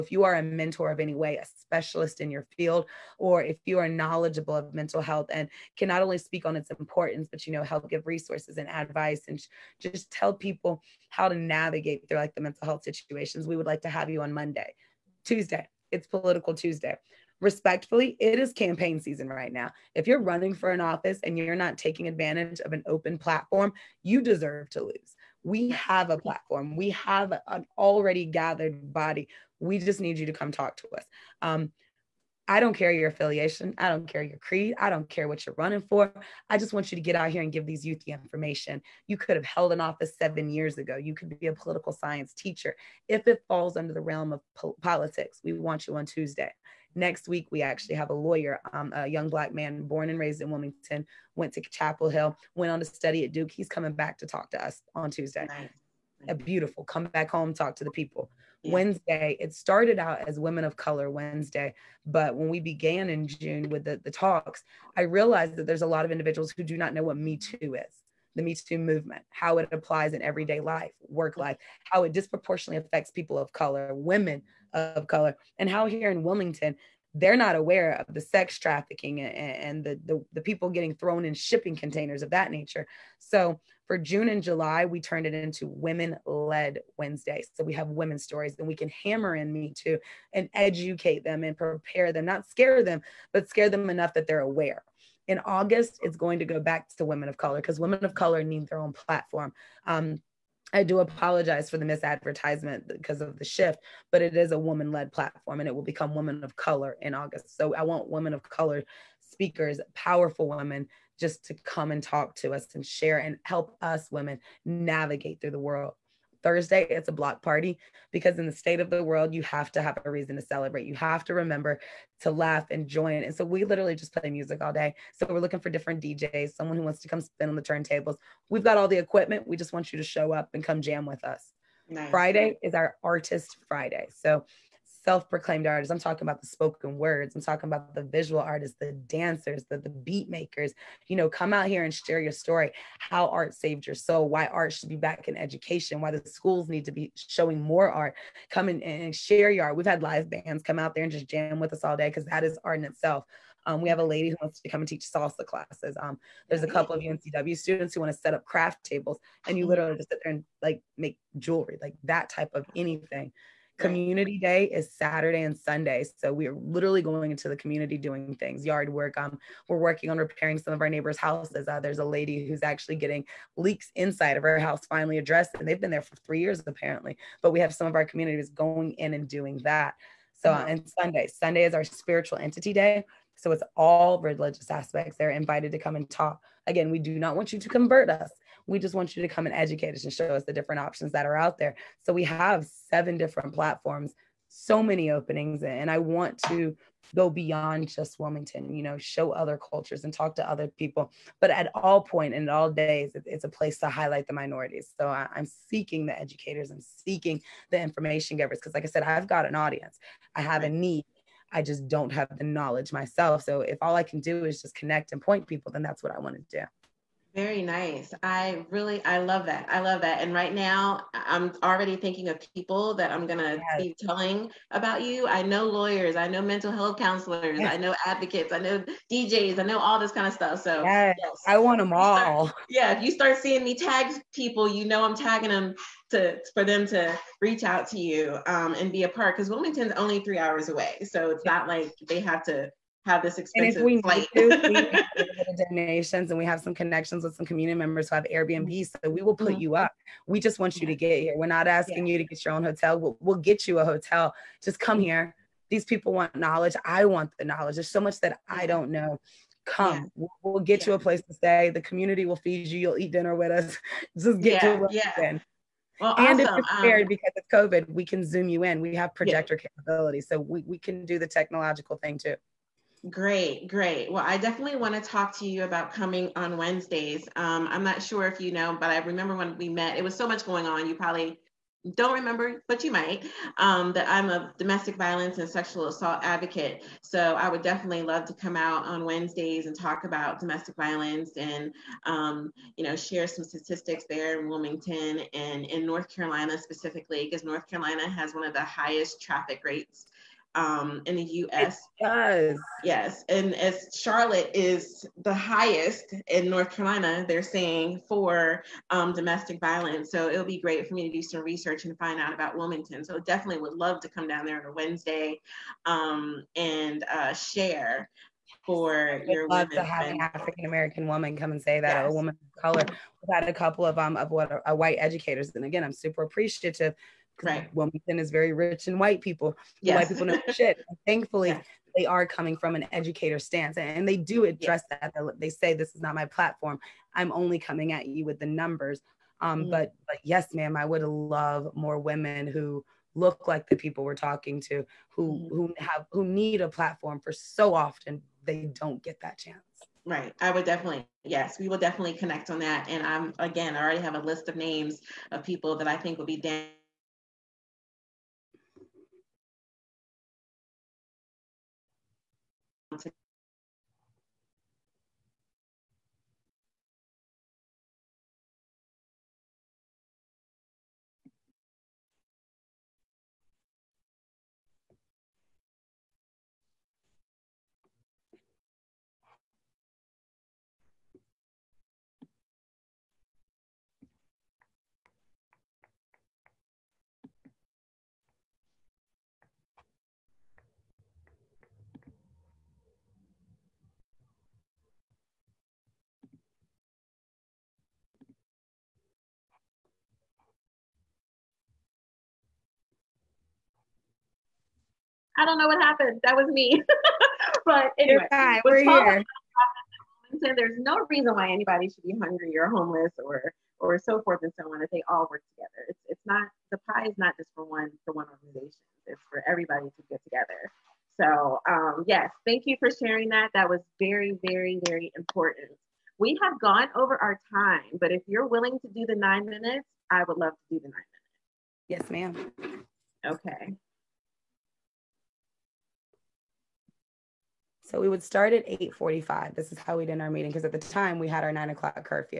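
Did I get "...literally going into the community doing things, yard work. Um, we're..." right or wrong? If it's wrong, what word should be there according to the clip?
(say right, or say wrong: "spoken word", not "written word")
right.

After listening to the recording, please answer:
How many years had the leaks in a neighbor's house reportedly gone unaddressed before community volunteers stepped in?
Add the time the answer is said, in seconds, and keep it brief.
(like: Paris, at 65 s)
3 years, at 176 s.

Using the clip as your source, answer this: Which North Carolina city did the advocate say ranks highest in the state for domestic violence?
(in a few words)
Charlotte.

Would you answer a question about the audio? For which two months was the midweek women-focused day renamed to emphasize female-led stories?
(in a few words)
June and July.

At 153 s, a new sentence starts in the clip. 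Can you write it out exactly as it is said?
Um, we have a lady who wants to come and teach salsa classes.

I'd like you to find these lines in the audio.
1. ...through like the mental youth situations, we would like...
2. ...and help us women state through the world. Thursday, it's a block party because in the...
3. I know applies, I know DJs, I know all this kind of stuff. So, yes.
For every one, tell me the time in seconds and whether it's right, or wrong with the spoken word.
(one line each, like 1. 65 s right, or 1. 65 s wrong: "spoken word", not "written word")
1. 12 s wrong: "health", not "youth"
2. 113 s wrong: "navigate", not "state"
3. 227 s wrong: "advocates", not "applies".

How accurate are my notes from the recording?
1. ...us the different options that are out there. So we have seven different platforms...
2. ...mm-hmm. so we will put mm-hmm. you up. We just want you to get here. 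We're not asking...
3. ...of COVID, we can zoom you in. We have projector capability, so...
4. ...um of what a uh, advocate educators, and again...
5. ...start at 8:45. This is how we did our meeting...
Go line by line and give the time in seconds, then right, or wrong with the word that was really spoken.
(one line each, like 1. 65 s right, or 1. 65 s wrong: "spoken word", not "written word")
1. 190 s right
2. 248 s right
3. 267 s right
4. 323 s wrong: "white", not "advocate"
5. 438 s right.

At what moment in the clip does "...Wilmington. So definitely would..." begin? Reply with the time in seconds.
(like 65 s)
312 s.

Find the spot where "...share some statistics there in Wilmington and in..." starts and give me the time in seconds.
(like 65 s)
292 s.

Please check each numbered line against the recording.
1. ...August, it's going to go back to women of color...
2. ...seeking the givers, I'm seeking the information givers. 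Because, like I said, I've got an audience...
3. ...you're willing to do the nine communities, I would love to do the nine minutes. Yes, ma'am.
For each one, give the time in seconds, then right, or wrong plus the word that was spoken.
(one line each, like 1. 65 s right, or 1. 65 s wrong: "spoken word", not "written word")
1. 95 s right
2. 205 s wrong: "educators", not "givers"
3. 428 s wrong: "minutes", not "communities".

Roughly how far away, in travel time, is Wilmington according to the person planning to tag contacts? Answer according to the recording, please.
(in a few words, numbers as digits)
3 hours.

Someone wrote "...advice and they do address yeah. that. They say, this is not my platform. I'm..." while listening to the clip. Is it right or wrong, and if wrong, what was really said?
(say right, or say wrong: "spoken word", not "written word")
wrong: "stance", not "advice".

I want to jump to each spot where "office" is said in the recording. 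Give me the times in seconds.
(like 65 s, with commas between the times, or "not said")
20 s, 39 s.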